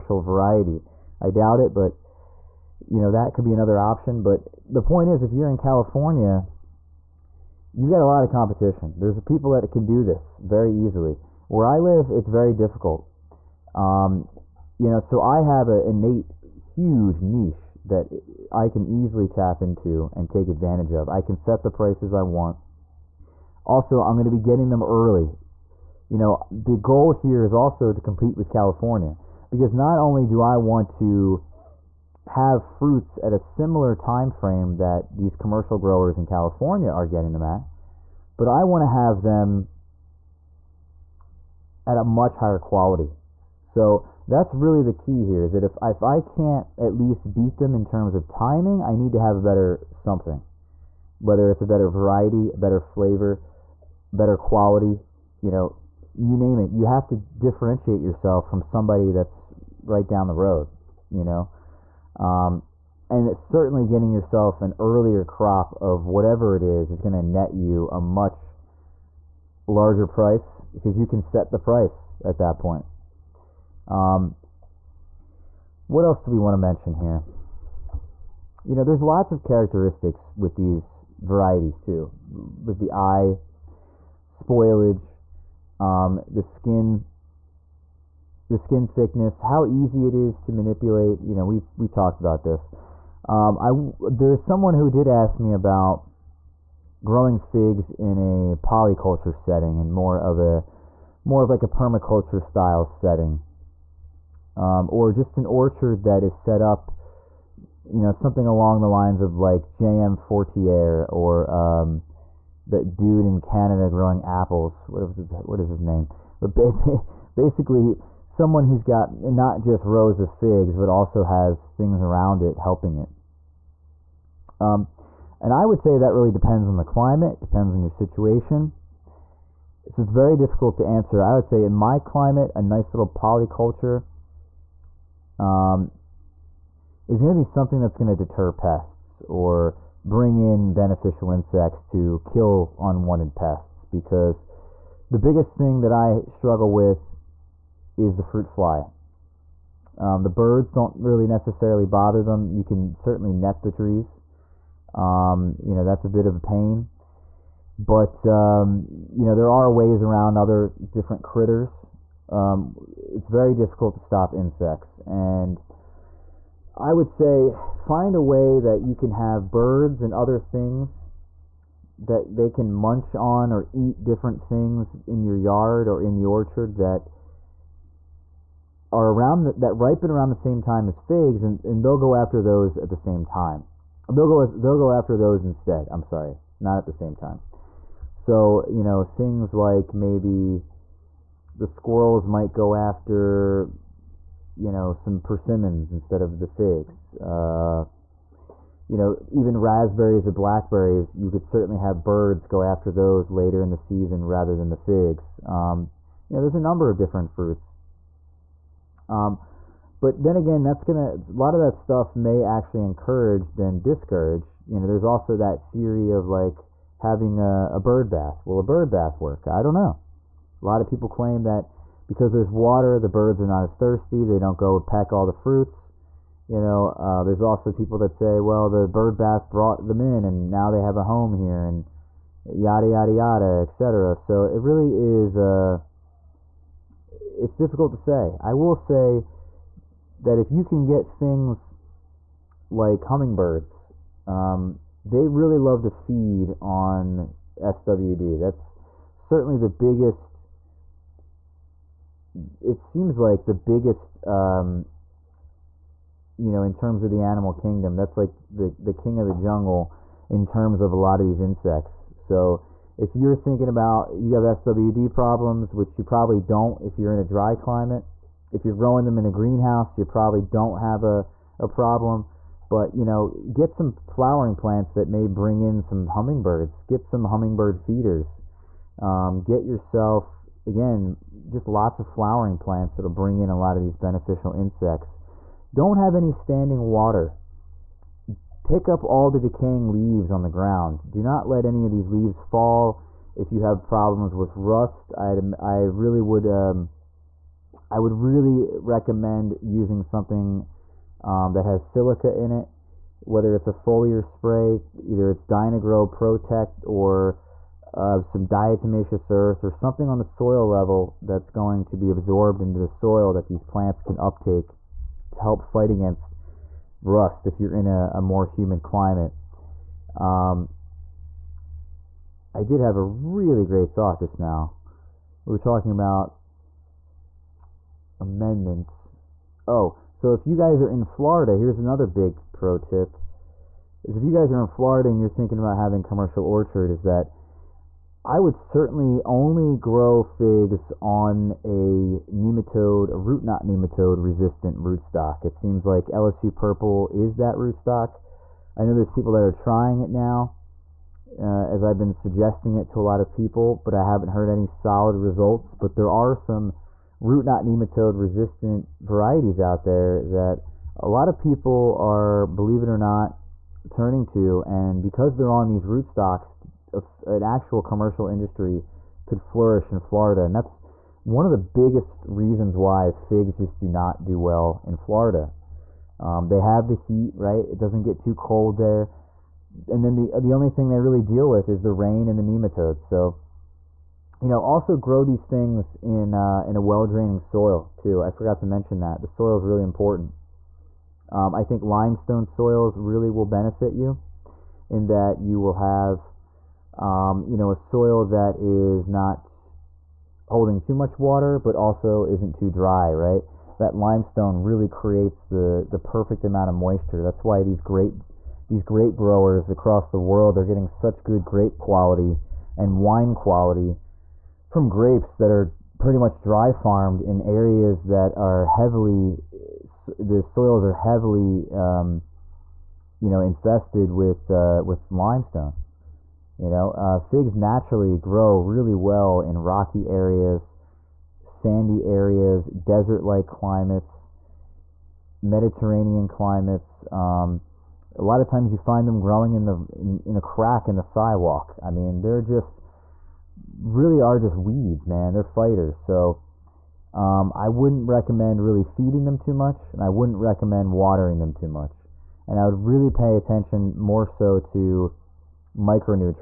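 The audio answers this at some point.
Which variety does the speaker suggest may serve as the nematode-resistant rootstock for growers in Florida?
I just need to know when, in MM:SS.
05:46.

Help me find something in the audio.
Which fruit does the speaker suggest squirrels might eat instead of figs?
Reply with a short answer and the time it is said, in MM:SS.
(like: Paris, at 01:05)
Persimmons, at 03:15.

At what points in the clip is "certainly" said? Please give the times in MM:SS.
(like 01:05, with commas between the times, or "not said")
01:03, 02:32, 03:21, 04:09, 05:38.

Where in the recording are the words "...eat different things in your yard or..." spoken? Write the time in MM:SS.
02:53.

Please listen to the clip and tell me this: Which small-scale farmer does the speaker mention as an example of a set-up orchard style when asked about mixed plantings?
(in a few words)
J.M. Fortier.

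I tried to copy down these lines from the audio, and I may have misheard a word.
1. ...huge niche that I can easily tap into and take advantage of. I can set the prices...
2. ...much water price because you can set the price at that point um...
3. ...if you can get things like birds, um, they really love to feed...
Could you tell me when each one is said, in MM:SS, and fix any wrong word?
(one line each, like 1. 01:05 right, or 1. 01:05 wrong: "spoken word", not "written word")
1. 00:16 right
2. 01:07 wrong: "larger", not "water"
3. 04:00 wrong: "hummingbirds", not "birds".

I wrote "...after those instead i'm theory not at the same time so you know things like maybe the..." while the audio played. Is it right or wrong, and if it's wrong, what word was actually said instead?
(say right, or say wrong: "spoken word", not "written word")
wrong: "sorry", not "theory".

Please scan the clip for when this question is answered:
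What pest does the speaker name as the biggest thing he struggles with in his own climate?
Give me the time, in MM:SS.
02:28.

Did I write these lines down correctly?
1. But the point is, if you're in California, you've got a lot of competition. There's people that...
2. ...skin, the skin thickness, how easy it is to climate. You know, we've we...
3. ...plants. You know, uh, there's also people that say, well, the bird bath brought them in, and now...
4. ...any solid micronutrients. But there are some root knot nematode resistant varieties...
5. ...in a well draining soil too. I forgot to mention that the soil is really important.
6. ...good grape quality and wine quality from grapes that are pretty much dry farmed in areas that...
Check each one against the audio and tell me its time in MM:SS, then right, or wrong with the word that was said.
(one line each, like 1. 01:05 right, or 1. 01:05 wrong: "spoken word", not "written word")
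1. 00:04 right
2. 01:26 wrong: "manipulate", not "climate"
3. 03:45 wrong: "fruits", not "plants"
4. 05:54 wrong: "results", not "micronutrients"
5. 06:26 right
6. 06:51 right.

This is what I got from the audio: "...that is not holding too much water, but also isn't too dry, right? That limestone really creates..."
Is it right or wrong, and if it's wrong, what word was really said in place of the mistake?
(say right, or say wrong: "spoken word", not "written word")
right.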